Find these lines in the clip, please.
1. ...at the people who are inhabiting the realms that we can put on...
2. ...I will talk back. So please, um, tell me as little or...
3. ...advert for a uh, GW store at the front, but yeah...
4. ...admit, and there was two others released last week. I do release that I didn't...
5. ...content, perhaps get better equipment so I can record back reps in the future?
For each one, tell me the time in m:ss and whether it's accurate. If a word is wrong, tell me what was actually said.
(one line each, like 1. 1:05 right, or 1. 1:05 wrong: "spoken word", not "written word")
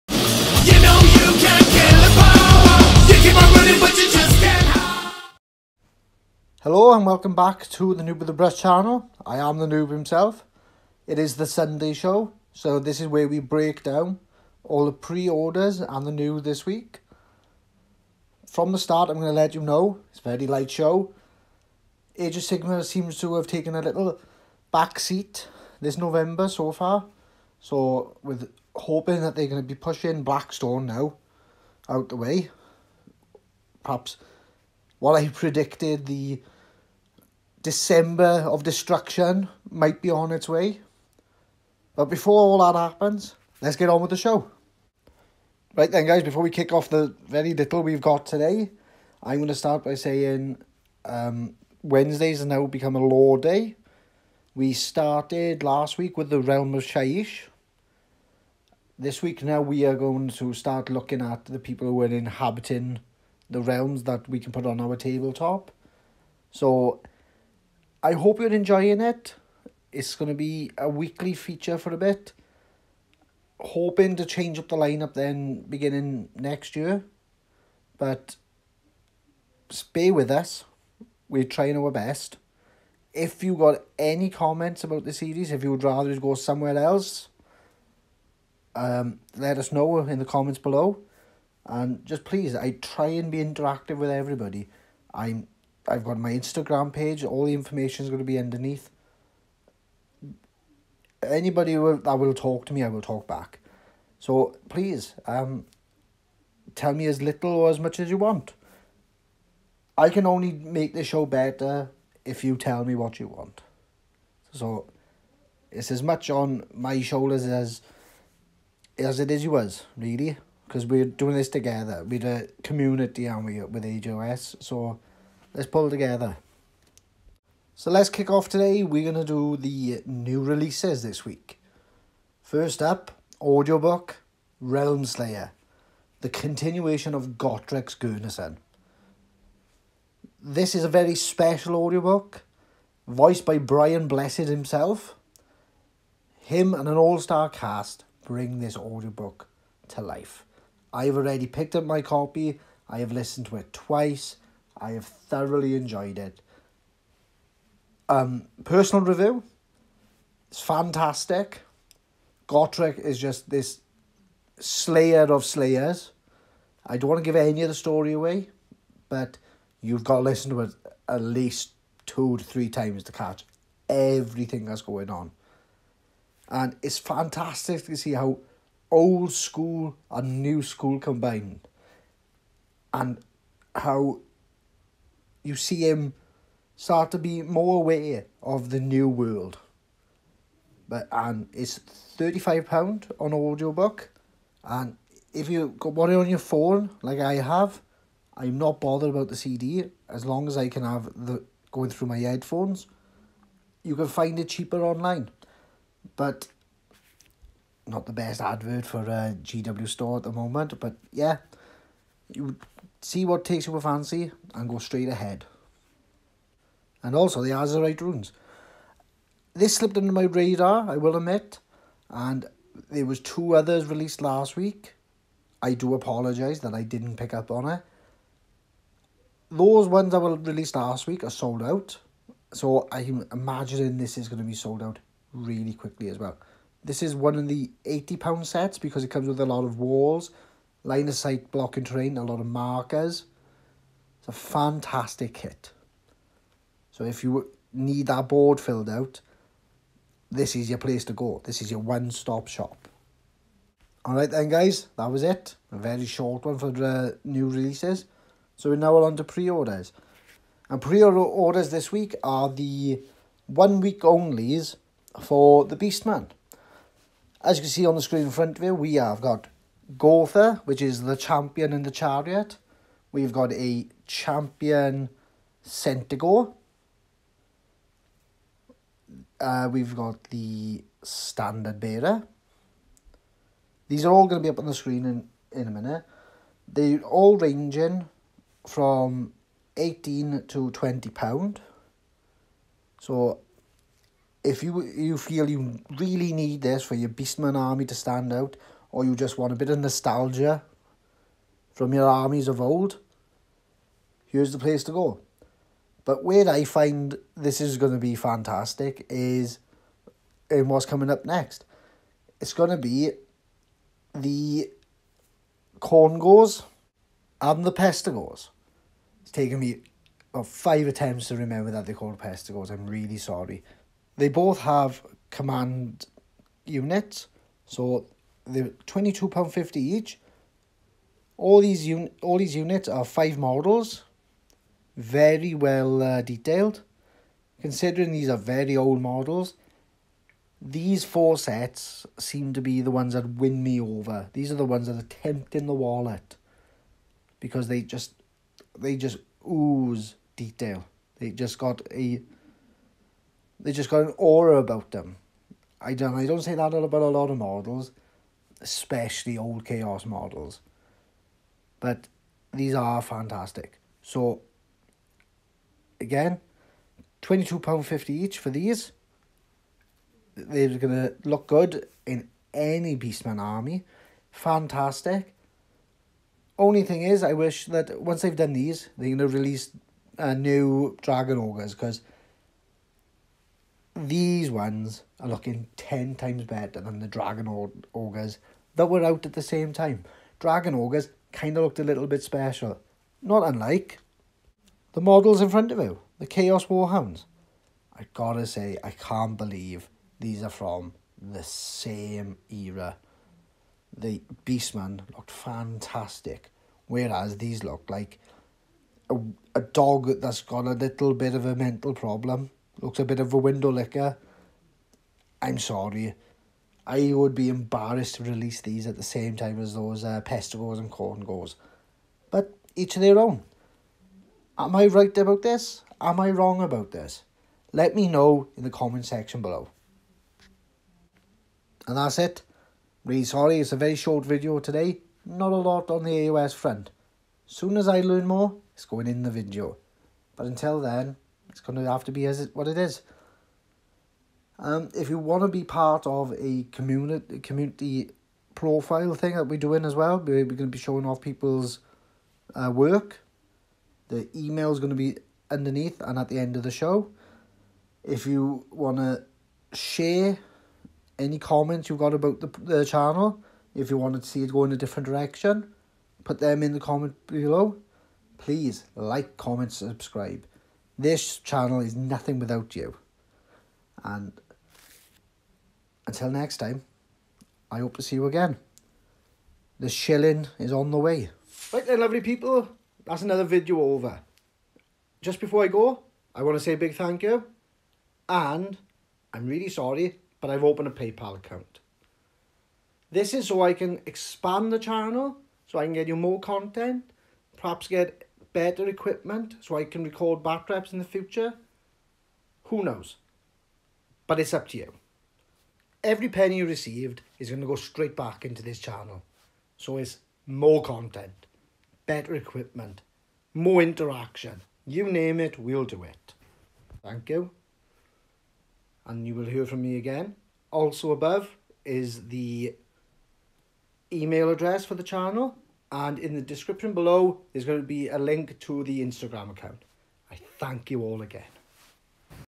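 1. 1:01 right
2. 1:42 right
3. 3:28 wrong: "moment", not "front"
4. 3:41 wrong: "apologise", not "release"
5. 8:16 right.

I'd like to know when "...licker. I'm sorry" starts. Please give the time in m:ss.
6:53.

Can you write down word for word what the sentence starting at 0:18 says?
From the start, I'm going to let you know, it's a very light show.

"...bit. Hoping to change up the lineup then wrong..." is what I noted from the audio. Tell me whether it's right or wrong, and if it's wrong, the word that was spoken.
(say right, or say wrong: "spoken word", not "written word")
wrong: "beginning", not "wrong".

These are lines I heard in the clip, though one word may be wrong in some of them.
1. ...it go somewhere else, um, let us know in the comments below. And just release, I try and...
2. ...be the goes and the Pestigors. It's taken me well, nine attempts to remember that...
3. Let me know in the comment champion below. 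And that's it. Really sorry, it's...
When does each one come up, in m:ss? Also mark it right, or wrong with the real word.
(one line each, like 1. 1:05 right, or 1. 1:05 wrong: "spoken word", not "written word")
1. 1:26 wrong: "please", not "release"
2. 5:12 wrong: "five", not "nine"
3. 7:07 wrong: "section", not "champion".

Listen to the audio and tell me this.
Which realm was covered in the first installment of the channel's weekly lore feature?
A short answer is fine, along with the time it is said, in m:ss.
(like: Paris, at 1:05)
Shyish, at 0:56.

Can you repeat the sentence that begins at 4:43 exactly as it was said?
These are all going to be up on the screen in, in a minute.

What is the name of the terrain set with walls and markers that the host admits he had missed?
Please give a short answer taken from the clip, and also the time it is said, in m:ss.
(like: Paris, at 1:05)
Azyrite Ruins, at 3:37.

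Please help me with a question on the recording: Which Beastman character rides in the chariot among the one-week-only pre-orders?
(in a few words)
Gorthor.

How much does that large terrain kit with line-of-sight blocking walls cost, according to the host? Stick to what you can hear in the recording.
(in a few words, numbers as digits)
£80.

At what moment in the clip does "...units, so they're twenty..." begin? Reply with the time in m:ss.
5:26.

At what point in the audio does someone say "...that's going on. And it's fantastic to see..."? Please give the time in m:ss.
2:54.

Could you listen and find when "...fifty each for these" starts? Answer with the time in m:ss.
6:07.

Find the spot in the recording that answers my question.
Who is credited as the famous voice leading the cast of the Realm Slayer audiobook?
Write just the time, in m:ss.
2:23.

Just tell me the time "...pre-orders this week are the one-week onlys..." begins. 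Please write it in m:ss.
4:20.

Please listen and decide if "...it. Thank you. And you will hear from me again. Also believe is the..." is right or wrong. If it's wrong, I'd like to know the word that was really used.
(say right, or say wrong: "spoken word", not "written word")
wrong: "above", not "believe".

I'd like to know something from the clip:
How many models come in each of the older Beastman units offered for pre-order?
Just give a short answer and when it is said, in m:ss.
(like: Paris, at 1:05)
5, at 5:33.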